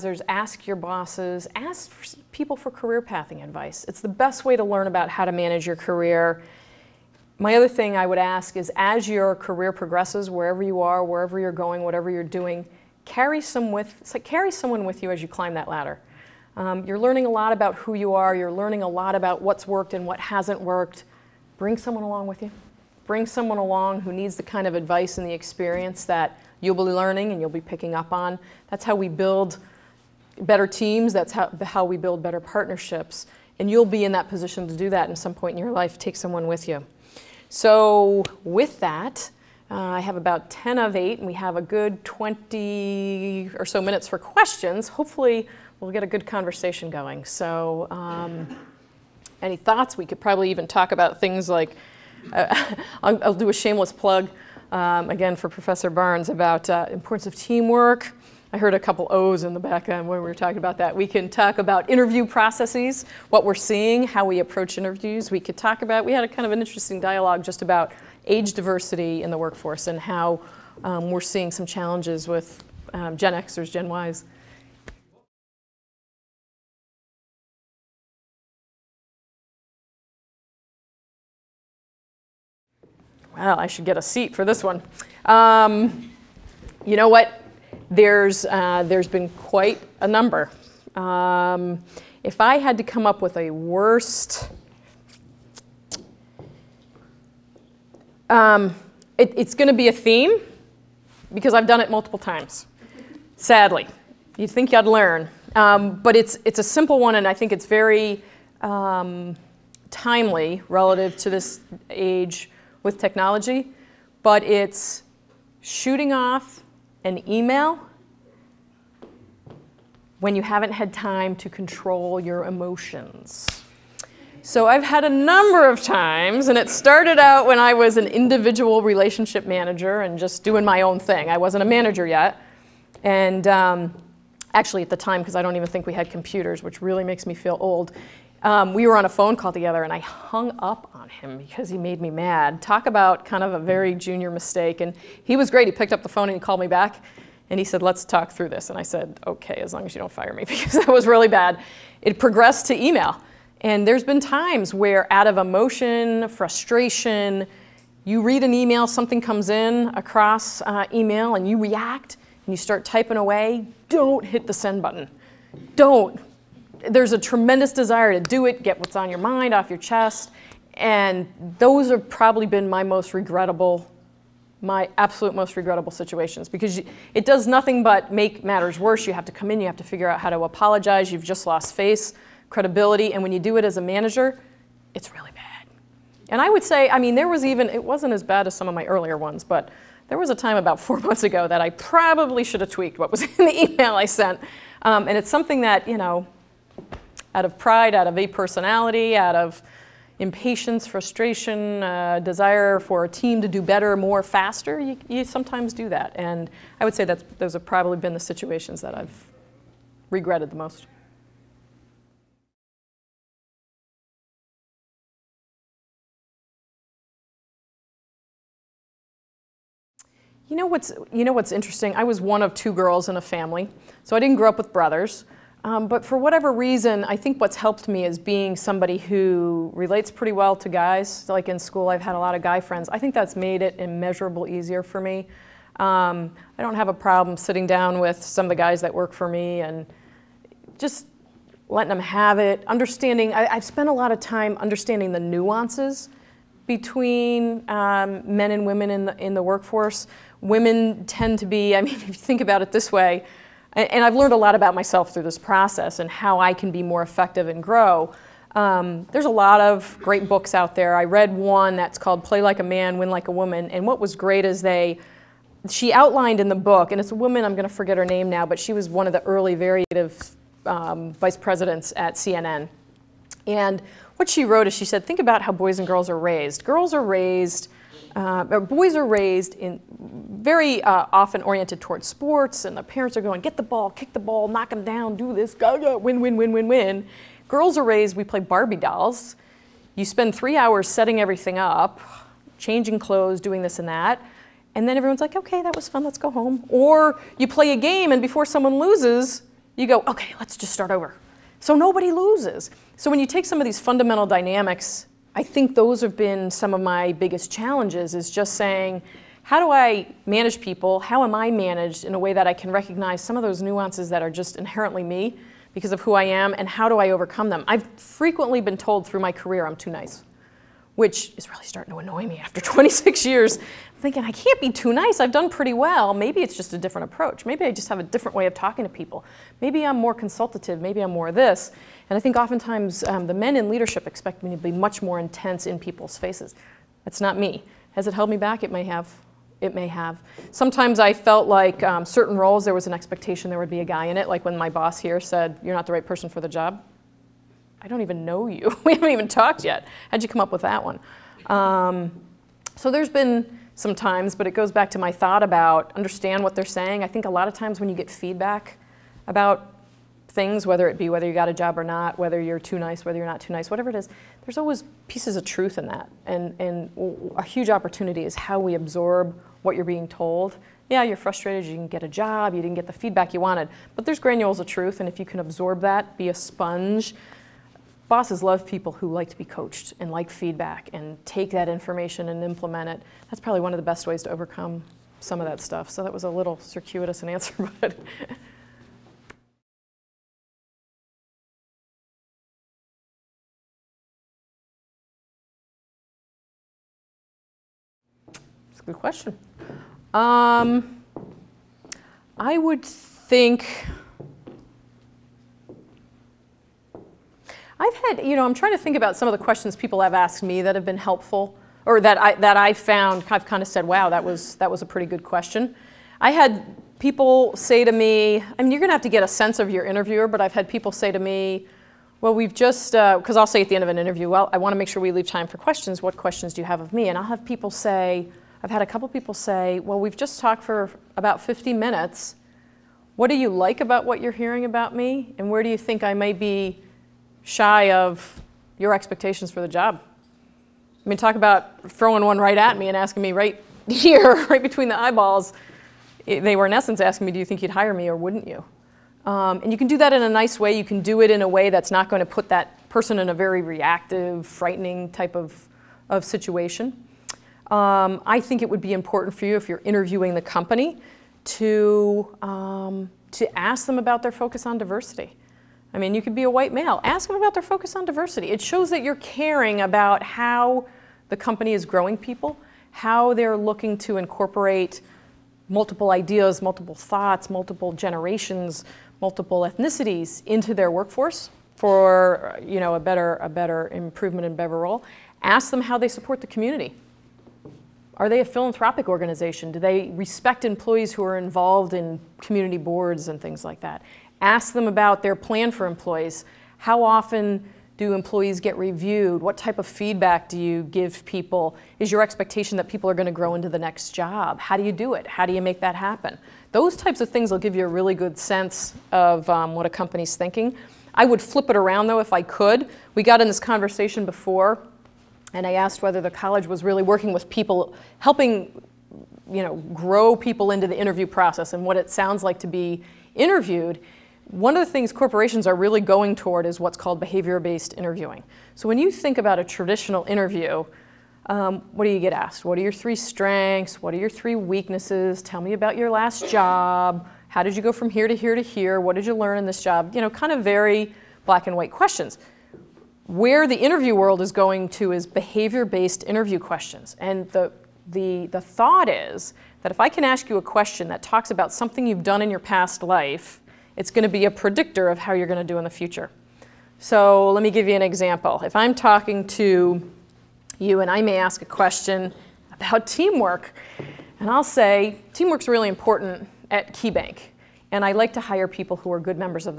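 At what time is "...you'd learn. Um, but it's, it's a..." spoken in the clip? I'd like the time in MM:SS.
01:44.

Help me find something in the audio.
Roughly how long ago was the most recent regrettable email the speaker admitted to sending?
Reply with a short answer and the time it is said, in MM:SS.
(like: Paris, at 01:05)
4 months, at 03:10.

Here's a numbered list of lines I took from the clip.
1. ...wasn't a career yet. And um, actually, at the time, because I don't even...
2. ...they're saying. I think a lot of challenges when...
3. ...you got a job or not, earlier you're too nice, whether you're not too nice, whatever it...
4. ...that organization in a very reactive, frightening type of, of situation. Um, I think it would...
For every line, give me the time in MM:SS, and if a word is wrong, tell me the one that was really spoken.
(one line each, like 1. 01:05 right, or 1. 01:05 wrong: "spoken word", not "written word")
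1. 02:11 wrong: "manager", not "career"
2. 05:56 wrong: "times", not "challenges"
3. 06:01 wrong: "whether", not "earlier"
4. 07:32 wrong: "person", not "organization".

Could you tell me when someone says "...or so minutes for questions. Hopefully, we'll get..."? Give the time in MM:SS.
00:43.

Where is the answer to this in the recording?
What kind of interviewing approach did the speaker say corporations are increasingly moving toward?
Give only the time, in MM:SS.
08:47.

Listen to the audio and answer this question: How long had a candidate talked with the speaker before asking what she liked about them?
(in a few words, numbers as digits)
about 50 minutes.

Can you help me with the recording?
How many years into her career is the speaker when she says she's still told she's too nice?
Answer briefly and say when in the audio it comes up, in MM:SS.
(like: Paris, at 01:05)
26, at 05:22.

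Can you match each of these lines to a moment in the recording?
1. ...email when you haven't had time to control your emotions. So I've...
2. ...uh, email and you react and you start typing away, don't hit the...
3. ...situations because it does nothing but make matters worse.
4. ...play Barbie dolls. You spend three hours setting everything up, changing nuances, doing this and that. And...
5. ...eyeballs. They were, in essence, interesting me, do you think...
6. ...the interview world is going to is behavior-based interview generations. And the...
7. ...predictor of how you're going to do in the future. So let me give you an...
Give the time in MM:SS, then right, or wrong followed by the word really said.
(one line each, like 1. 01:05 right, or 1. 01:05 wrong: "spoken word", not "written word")
1. 01:57 right
2. 02:40 right
3. 02:55 right
4. 04:48 wrong: "clothes", not "nuances"
5. 07:24 wrong: "asking", not "interesting"
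6. 09:03 wrong: "questions", not "generations"
7. 09:14 right.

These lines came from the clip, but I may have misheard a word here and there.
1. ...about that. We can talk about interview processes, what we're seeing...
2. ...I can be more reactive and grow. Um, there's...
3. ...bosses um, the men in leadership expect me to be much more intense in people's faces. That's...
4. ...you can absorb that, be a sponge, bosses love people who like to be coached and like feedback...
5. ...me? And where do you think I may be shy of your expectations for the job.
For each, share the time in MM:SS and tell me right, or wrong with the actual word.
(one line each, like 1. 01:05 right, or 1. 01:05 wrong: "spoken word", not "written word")
1. 01:00 right
2. 04:16 wrong: "effective", not "reactive"
3. 05:32 wrong: "oftentimes", not "bosses"
4. 06:15 right
5. 07:14 right.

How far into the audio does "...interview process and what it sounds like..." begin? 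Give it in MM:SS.
08:40.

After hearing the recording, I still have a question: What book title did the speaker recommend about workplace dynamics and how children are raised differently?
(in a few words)
Play Like a Man, Win Like a Woman.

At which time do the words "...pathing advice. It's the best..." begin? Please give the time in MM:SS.
00:02.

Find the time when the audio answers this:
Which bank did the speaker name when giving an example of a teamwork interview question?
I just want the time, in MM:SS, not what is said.
09:26.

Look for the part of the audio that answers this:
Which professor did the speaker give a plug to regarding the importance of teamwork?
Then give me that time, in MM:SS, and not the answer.
00:55.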